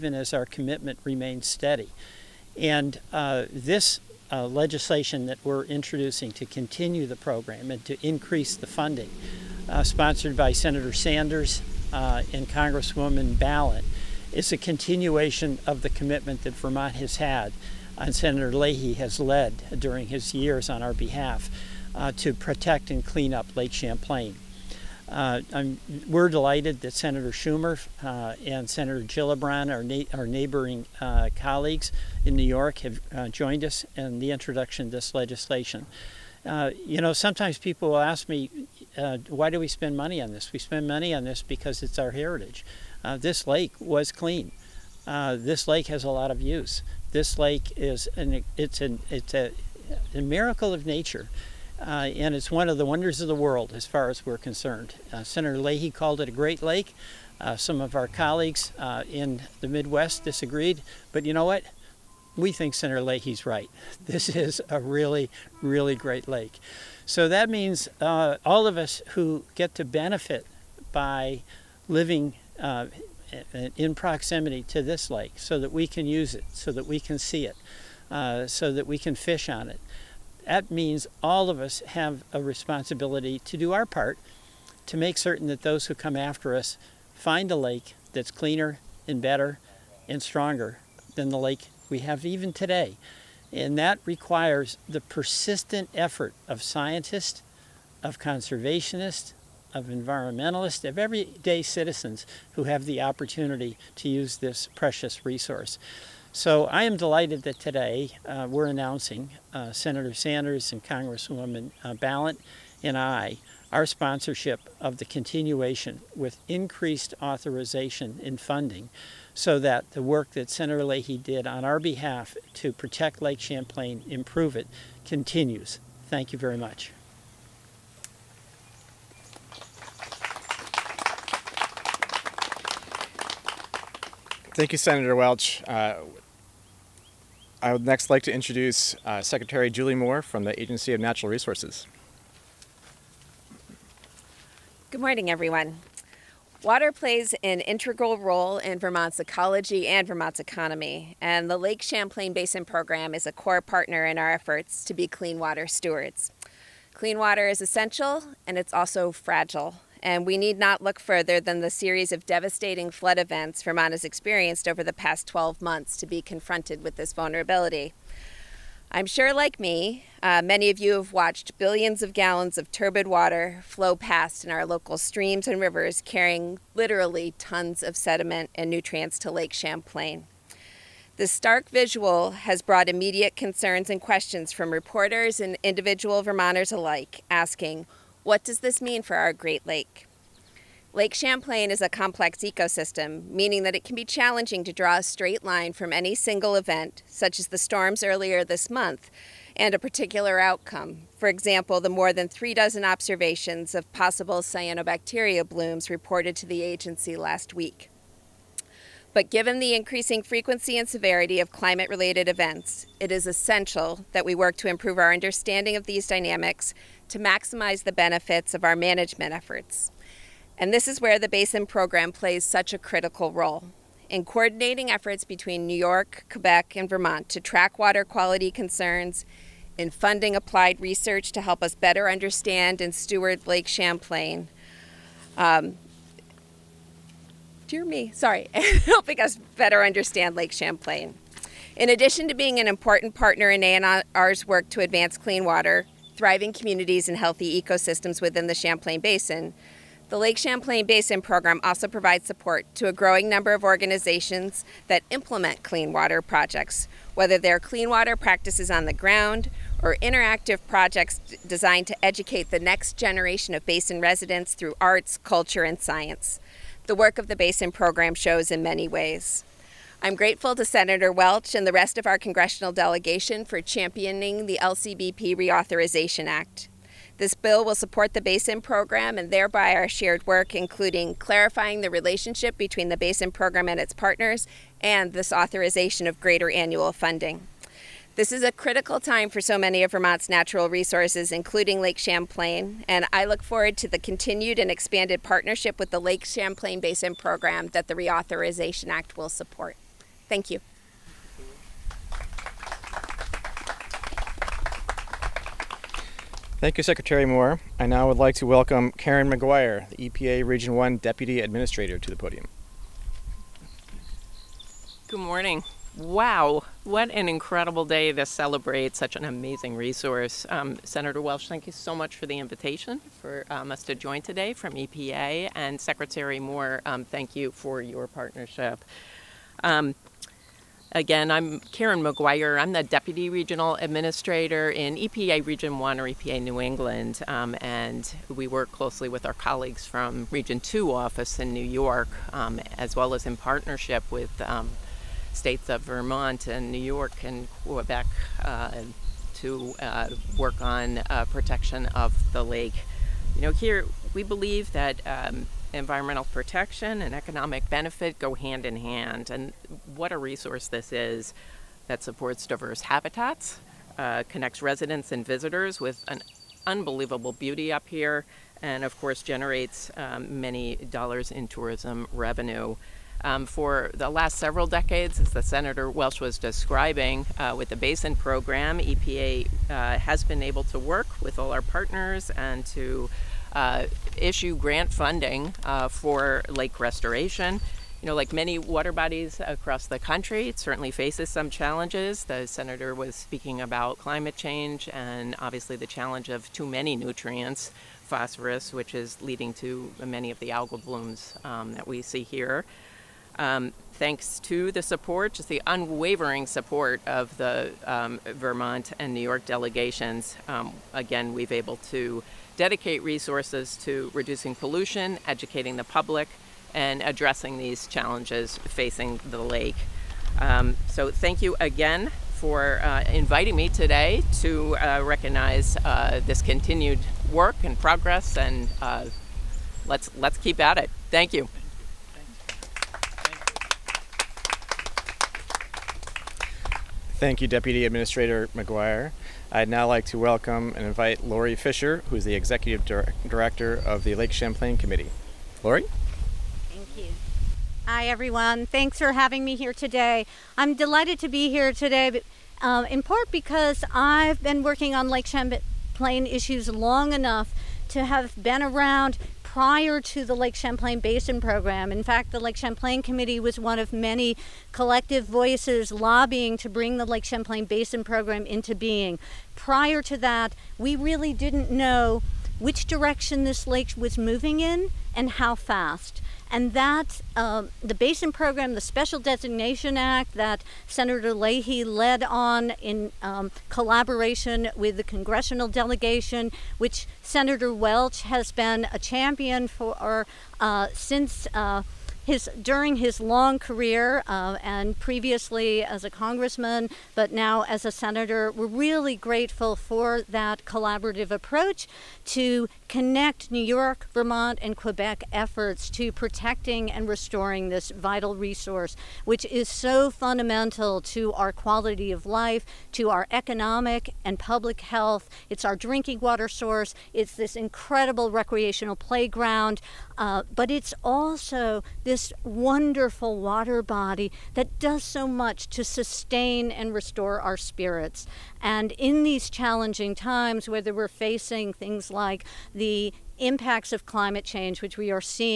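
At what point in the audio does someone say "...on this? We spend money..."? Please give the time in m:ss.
0:40.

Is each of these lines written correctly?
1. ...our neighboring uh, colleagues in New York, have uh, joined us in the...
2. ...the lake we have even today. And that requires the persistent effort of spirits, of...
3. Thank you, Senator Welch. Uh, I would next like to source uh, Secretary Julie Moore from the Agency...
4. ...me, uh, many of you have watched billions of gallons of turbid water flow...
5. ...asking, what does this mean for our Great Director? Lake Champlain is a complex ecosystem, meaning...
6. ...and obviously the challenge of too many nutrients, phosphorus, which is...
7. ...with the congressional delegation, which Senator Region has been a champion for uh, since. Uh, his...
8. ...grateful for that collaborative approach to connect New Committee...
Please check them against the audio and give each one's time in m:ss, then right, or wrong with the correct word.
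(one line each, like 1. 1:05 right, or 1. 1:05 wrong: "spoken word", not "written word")
1. 0:30 right
2. 1:31 wrong: "scientists", not "spirits"
3. 2:14 wrong: "introduce", not "source"
4. 2:49 right
5. 3:07 wrong: "Lake", not "Director"
6. 6:34 right
7. 8:04 wrong: "Welch", not "Region"
8. 8:19 wrong: "York", not "Committee".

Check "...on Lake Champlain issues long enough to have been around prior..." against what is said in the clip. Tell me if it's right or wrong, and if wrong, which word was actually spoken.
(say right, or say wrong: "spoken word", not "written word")
right.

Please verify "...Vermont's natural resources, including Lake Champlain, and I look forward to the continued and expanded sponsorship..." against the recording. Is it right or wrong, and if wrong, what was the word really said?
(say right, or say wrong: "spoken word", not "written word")
wrong: "partnership", not "sponsorship".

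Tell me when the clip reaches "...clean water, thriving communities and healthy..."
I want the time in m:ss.
4:05.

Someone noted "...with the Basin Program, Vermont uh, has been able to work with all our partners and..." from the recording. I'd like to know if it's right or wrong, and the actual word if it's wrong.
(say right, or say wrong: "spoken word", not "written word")
wrong: "EPA", not "Vermont".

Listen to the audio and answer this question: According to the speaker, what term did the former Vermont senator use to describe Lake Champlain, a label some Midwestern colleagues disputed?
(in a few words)
a great lake.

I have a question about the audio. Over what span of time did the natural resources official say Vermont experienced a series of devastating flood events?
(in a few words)
12 months.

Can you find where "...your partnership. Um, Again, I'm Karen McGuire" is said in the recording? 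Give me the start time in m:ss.
5:27.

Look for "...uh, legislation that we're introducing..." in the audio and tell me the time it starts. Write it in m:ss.
0:04.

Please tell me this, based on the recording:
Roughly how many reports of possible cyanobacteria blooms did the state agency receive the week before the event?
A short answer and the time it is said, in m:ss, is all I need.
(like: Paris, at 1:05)
more than three dozen, at 3:21.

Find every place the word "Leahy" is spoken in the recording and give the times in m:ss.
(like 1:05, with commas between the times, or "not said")
0:18, 0:55, 1:03, 2:00, 8:01.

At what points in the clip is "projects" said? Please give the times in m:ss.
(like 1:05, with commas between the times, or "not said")
4:16, 4:20.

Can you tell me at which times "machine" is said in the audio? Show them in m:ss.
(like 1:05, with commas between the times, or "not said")
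not said.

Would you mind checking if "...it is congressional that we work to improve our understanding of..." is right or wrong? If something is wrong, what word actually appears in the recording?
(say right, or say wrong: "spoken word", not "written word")
wrong: "essential", not "congressional".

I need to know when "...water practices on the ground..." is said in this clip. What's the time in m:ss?
4:17.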